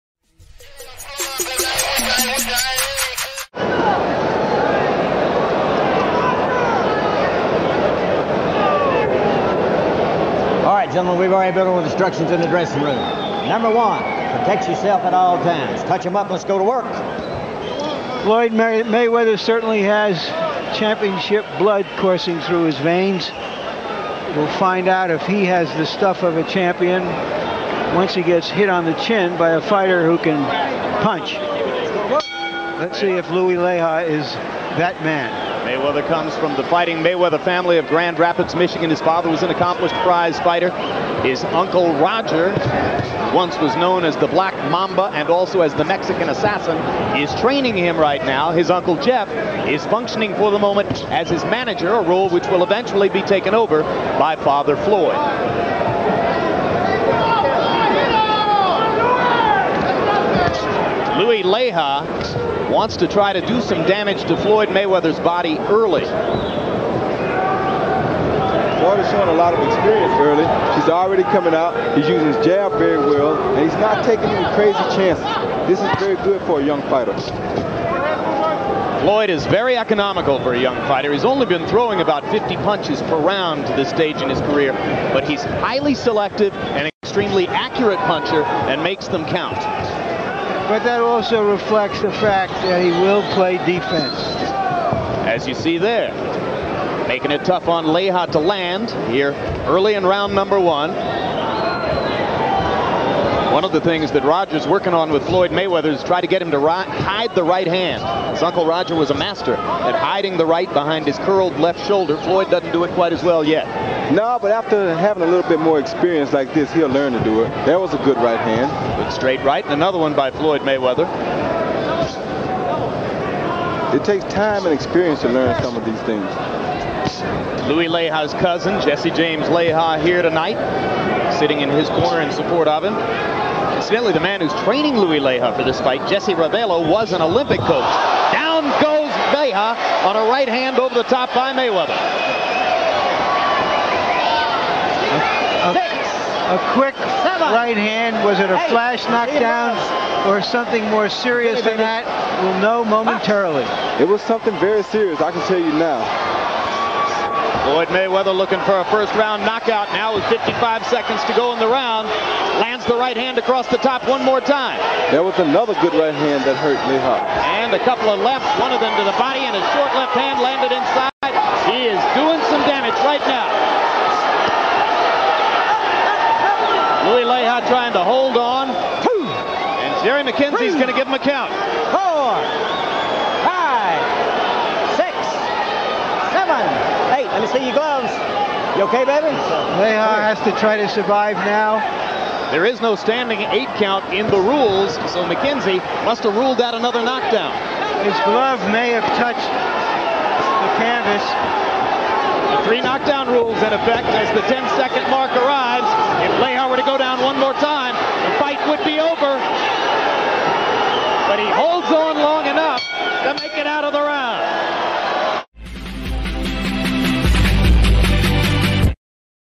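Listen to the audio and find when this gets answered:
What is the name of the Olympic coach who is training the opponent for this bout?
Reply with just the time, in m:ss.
2:16.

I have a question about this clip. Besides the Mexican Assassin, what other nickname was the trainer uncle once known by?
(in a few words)
the Black Mamba.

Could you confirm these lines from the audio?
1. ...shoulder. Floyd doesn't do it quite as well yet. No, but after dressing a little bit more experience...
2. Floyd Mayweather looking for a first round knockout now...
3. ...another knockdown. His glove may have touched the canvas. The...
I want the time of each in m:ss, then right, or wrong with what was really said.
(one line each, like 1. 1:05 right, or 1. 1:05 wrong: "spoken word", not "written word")
1. 1:51 wrong: "having", not "dressing"
2. 2:37 right
3. 3:16 right.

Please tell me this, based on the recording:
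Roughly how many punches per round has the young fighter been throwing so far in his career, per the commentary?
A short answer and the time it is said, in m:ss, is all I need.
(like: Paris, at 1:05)
50, at 1:22.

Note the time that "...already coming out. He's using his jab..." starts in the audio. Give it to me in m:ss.
1:10.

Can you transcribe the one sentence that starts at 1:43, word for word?
One of the things that Roger's working on with Floyd Mayweather is try to get him to ri- hide the right hand.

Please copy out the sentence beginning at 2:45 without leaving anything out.
There was another good right hand that hurt Mayhawk.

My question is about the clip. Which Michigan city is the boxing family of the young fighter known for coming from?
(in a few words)
Grand Rapids.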